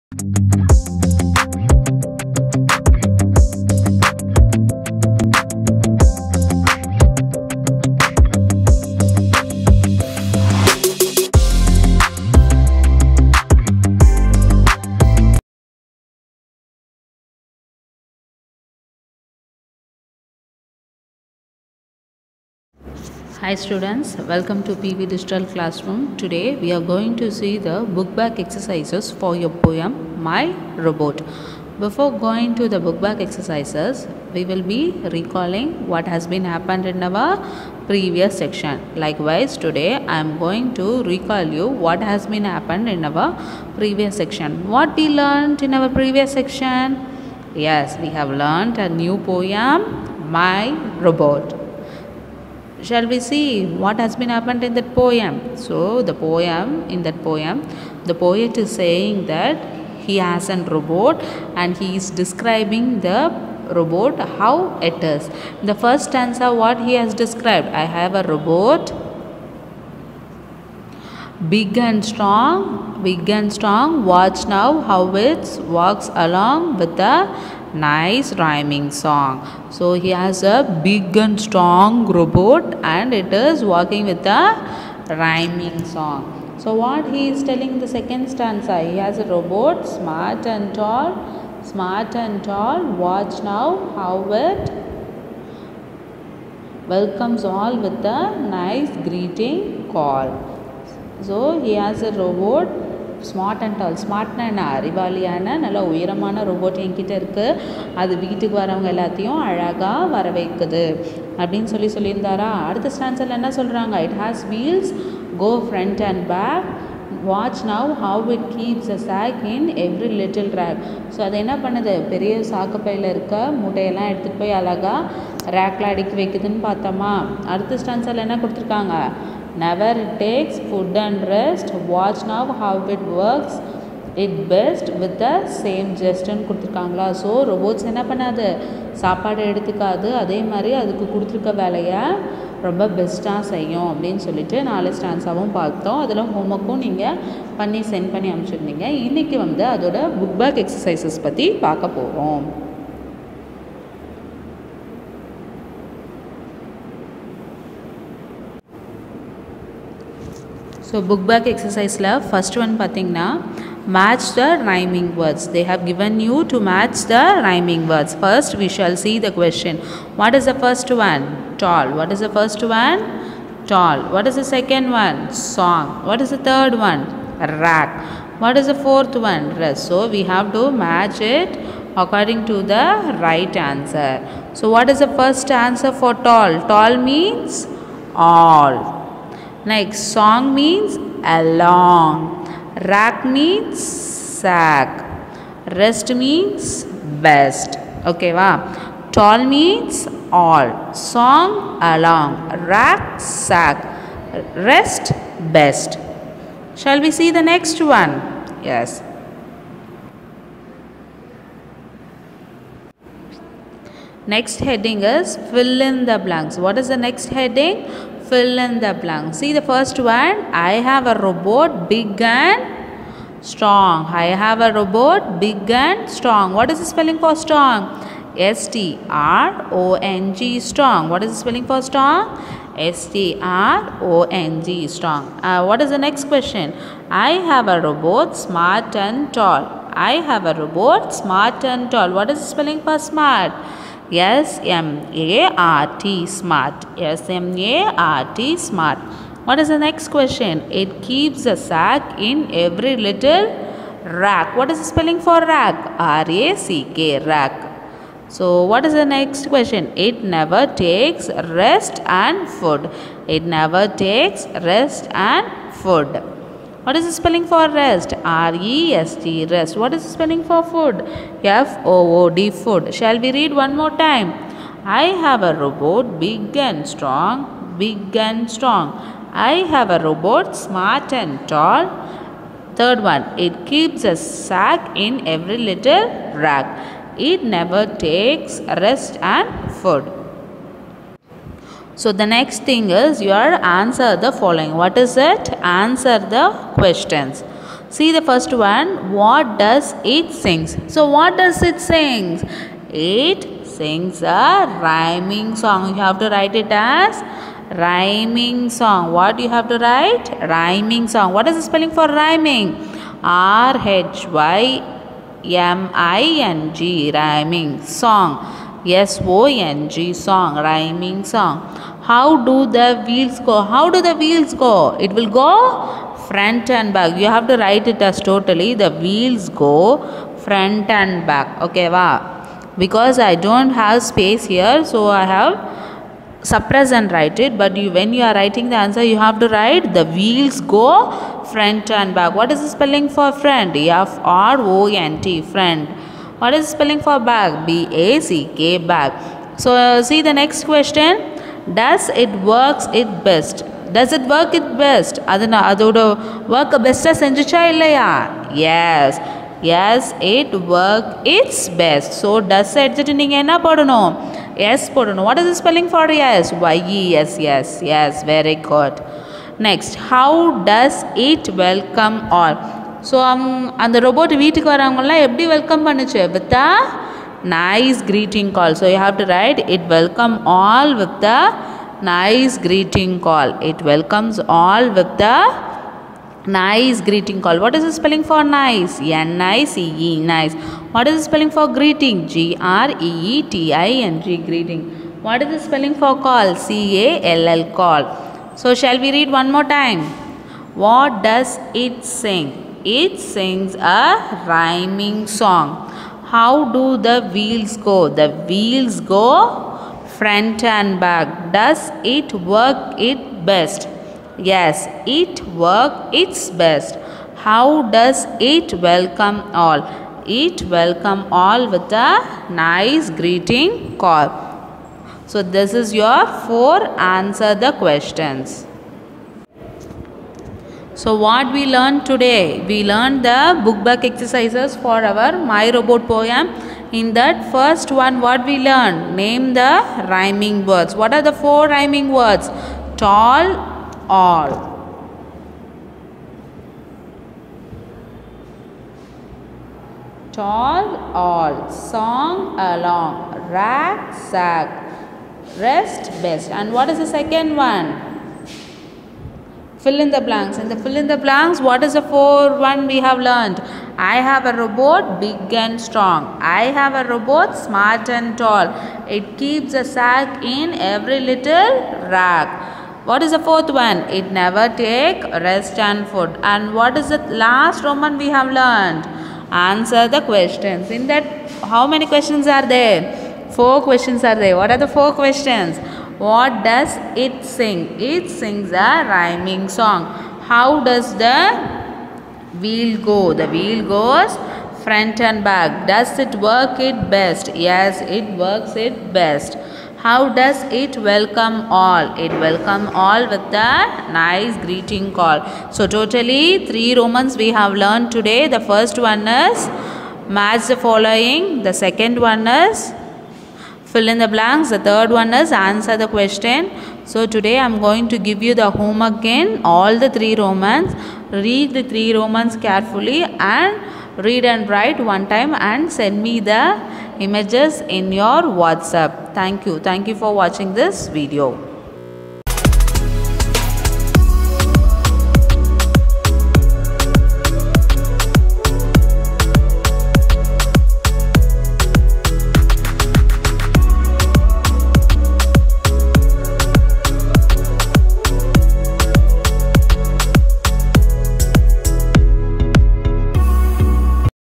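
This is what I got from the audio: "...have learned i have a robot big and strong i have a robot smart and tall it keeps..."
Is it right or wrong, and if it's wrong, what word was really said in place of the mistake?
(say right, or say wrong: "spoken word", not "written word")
right.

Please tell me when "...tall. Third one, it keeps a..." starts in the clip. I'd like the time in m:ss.
4:41.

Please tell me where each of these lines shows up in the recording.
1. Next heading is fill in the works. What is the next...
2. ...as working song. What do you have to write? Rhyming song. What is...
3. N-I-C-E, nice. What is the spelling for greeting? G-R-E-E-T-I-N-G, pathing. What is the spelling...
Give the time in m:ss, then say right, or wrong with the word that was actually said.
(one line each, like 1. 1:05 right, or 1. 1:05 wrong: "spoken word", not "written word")
1. 3:34 wrong: "blanks", not "works"
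2. 5:06 wrong: "rhyming", not "working"
3. 6:28 wrong: "greeting", not "pathing".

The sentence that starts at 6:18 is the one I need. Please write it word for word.
So you have to write it welcome all with the nice greeting call.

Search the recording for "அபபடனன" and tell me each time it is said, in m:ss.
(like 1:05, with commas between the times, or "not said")
1:51, 2:23.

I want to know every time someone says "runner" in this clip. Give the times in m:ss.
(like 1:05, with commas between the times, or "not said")
not said.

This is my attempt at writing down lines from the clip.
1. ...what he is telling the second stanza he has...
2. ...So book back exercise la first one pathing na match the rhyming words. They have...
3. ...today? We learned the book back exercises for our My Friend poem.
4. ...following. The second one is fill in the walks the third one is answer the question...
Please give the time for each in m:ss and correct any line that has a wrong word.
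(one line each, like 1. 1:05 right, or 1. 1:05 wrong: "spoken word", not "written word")
1. 1:26 right
2. 2:40 right
3. 7:12 wrong: "Robot", not "Friend"
4. 8:30 wrong: "blanks", not "walks".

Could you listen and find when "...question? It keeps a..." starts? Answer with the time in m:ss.
4:10.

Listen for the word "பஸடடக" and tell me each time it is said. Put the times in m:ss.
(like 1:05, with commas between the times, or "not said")
2:22, 5:56.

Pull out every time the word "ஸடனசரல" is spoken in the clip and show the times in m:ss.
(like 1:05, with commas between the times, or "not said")
1:52.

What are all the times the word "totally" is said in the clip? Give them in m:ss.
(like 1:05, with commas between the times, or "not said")
5:28, 8:25.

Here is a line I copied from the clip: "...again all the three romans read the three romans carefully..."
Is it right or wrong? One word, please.
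right.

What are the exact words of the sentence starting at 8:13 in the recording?
The wheel goes front and back.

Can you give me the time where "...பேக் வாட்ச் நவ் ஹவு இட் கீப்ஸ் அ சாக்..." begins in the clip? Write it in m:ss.
1:56.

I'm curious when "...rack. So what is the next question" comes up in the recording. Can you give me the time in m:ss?
4:17.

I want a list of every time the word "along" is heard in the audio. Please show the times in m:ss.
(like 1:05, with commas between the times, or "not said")
1:16, 3:11, 3:21, 7:32.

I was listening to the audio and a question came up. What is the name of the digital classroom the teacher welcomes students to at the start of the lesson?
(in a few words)
PV Digital Classroom.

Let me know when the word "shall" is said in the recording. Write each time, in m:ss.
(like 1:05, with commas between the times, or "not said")
0:52, 2:48, 3:26, 4:32, 6:38.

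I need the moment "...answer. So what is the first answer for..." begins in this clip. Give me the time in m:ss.
3:03.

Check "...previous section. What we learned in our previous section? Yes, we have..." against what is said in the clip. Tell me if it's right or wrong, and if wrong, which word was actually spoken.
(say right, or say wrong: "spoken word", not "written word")
right.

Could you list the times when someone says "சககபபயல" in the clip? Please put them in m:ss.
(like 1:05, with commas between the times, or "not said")
2:02.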